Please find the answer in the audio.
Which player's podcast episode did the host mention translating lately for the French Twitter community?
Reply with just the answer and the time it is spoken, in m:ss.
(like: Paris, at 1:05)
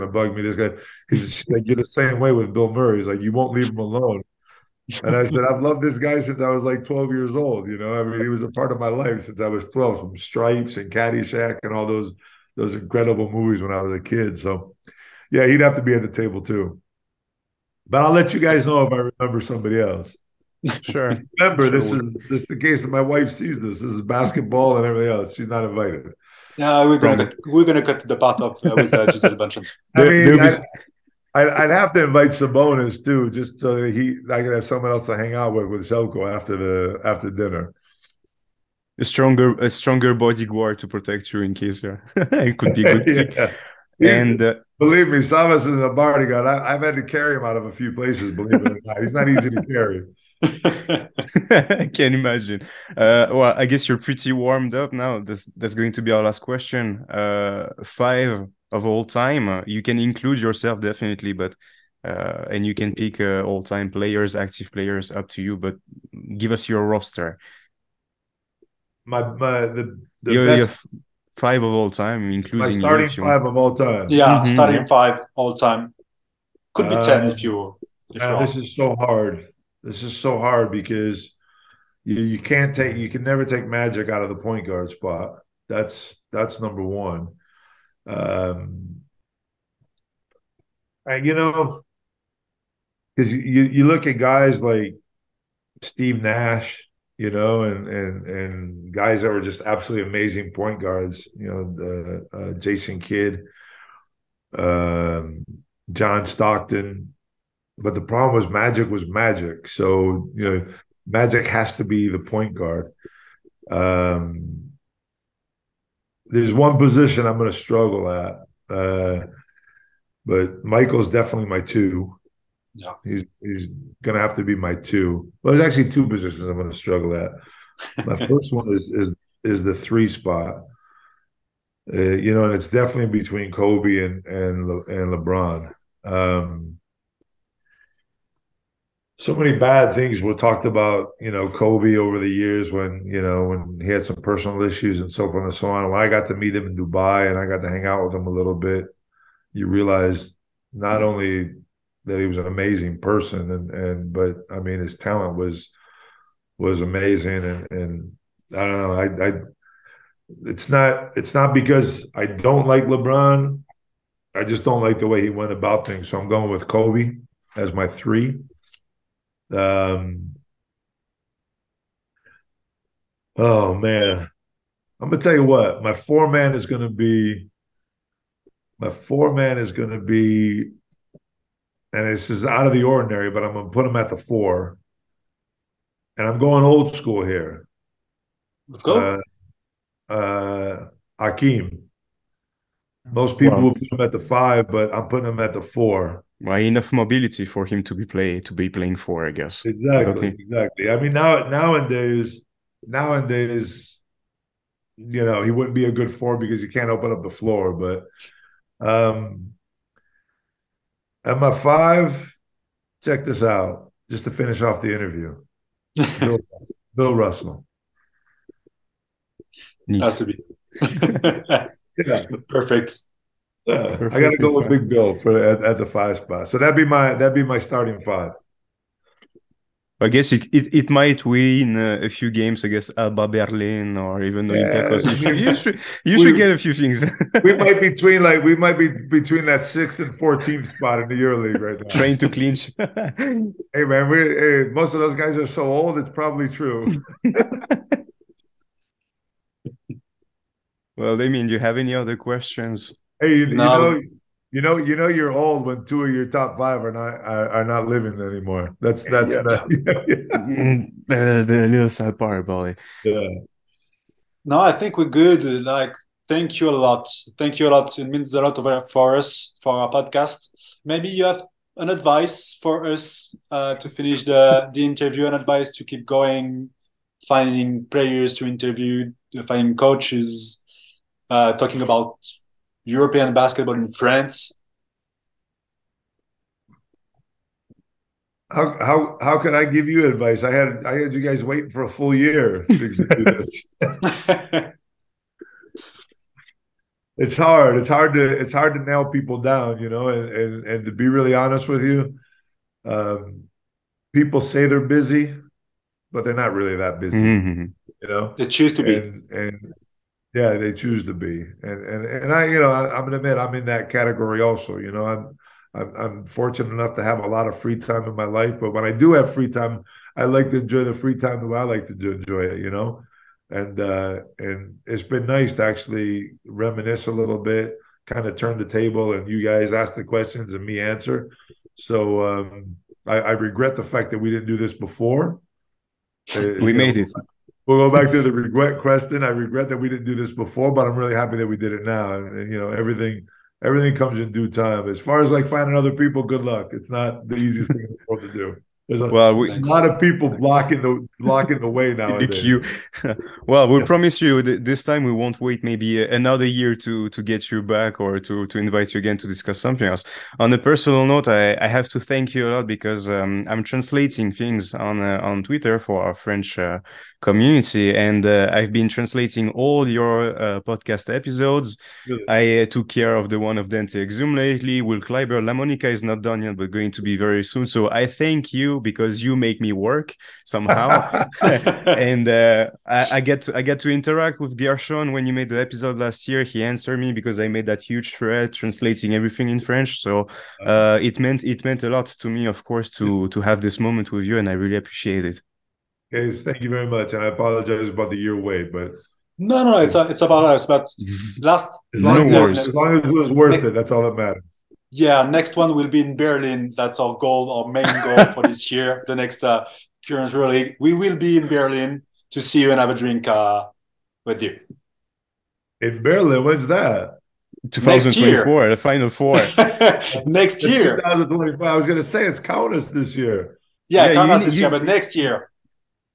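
Dante Exum, at 6:13.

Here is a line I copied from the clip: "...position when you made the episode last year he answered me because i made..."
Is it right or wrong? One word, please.
wrong.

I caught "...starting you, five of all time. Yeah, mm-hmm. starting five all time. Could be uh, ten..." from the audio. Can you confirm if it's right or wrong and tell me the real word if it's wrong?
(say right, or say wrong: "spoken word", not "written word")
right.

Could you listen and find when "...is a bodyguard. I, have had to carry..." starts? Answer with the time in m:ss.
0:45.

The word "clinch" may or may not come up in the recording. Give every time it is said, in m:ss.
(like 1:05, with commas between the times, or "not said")
4:02.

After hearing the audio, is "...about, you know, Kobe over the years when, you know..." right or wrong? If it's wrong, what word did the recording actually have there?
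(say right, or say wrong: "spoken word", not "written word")
right.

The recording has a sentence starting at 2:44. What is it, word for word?
I just don't like the way he went about things.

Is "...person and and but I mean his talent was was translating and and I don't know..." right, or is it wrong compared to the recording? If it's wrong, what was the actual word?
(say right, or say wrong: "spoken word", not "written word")
wrong: "amazing", not "translating".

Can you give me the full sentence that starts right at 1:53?
Um, there's one position I'm going to struggle at, uh, but Michael's definitely my two.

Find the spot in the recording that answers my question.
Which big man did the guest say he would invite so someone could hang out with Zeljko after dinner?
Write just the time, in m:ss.
0:32.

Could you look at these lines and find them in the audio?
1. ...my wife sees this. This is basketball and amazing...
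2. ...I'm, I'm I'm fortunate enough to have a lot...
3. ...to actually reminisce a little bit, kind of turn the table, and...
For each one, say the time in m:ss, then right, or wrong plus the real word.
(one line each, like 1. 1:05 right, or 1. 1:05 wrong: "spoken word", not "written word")
1. 0:22 wrong: "everything", not "amazing"
2. 5:15 right
3. 5:25 right.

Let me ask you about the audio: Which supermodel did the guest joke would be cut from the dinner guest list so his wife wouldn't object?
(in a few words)
Gisele Bündchen.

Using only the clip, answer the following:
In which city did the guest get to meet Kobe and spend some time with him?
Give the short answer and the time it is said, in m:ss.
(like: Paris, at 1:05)
Dubai, at 2:26.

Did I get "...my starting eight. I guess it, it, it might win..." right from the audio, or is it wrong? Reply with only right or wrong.
wrong.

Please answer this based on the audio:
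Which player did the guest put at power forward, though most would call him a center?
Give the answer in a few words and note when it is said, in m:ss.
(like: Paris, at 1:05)
Akeem, at 3:11.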